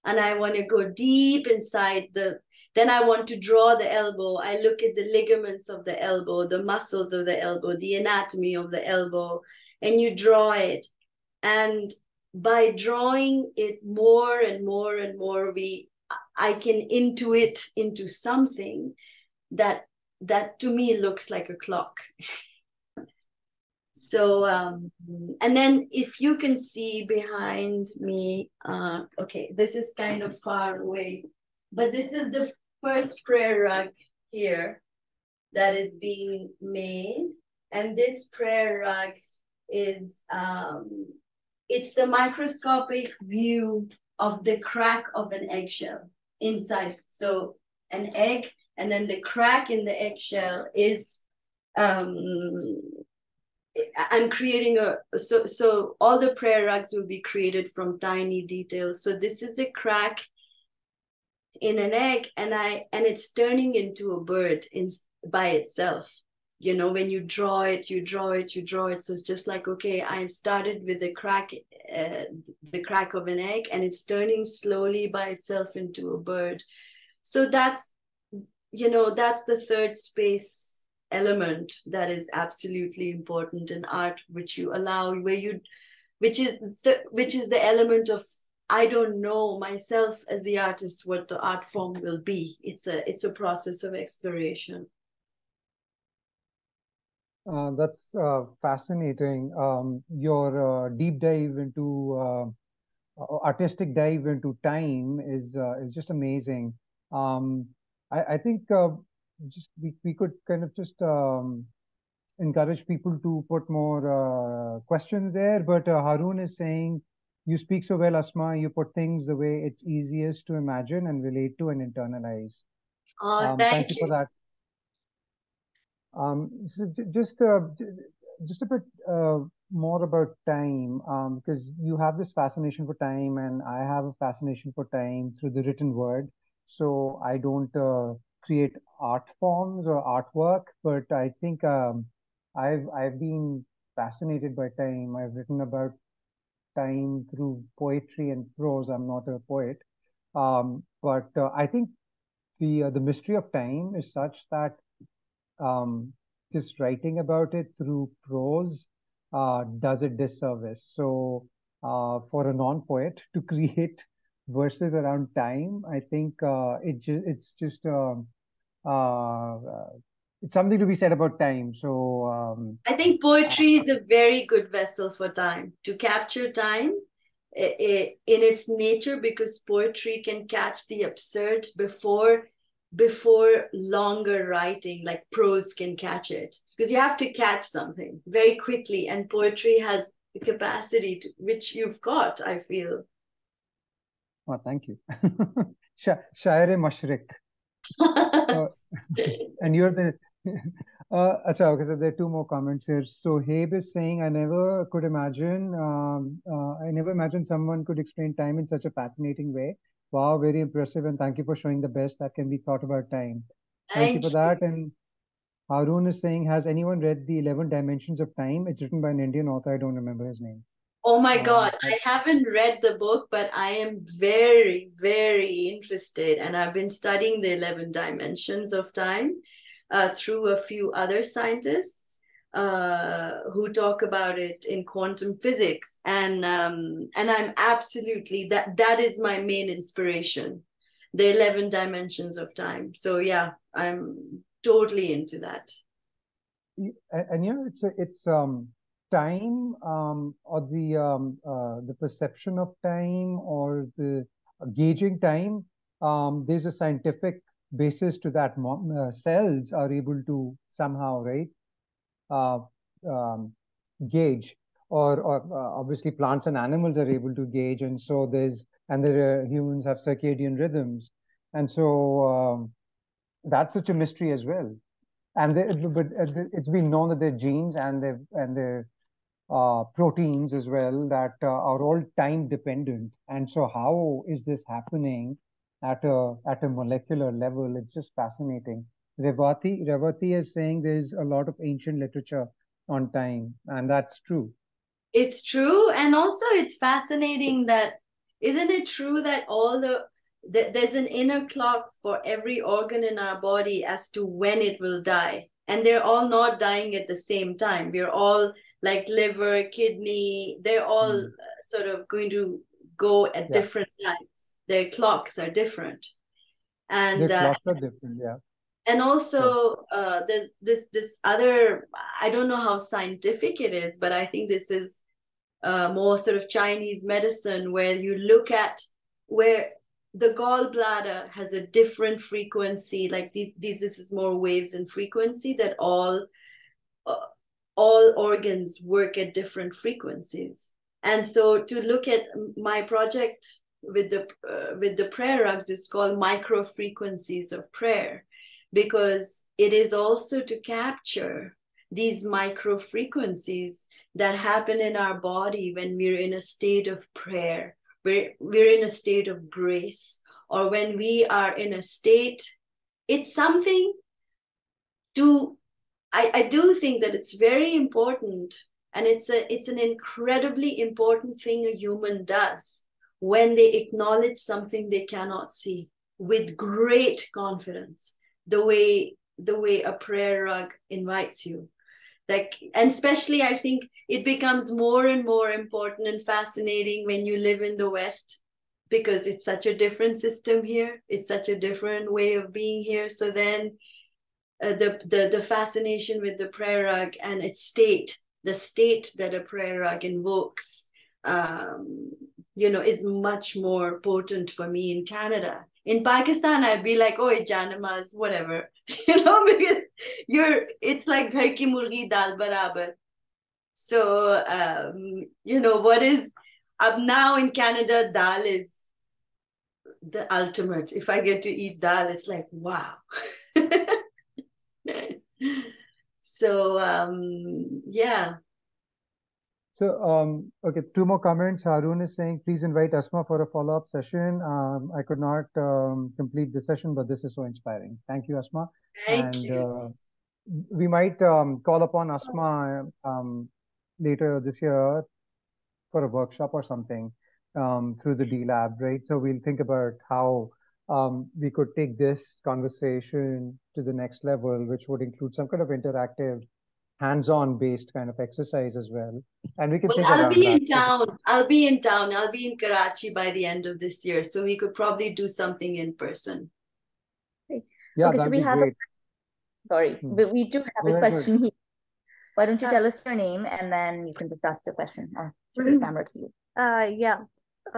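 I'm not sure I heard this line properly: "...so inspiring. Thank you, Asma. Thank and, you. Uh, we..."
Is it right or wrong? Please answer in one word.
right.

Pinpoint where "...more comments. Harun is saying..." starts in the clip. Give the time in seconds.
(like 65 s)
431 s.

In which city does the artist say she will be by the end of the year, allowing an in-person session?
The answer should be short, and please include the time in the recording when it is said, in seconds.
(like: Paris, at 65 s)
Karachi, at 462 s.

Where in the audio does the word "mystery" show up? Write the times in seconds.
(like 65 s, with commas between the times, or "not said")
152 s, 273 s.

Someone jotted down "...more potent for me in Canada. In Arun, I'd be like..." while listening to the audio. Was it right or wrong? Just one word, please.
wrong.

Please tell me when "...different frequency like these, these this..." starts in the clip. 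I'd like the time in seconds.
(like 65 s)
331 s.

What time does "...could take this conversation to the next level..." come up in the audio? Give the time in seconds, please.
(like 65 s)
451 s.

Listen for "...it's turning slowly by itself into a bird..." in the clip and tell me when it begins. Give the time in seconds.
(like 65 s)
73 s.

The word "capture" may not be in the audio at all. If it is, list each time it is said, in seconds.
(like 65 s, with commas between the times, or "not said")
175 s, 350 s.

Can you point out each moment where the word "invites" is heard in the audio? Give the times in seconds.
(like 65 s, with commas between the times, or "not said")
380 s, 432 s.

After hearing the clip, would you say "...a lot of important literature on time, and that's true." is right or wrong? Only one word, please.
wrong.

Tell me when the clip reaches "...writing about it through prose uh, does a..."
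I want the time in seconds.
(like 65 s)
156 s.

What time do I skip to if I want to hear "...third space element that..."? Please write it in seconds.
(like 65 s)
79 s.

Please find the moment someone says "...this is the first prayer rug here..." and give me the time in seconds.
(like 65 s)
31 s.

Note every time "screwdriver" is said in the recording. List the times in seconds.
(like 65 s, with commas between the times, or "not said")
not said.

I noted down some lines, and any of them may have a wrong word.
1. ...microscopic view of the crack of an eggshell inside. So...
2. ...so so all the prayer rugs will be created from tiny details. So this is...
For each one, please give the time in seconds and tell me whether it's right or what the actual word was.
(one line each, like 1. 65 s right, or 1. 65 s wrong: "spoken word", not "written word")
1. 42 s right
2. 55 s right.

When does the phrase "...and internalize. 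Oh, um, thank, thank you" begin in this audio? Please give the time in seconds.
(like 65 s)
121 s.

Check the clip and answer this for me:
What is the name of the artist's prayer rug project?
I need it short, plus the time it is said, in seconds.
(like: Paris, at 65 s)
Micro Frequencies of Prayer, at 346 s.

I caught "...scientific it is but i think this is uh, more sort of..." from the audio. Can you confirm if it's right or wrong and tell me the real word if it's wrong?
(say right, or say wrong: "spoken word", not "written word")
right.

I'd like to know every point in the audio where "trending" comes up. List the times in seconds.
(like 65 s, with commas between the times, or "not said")
not said.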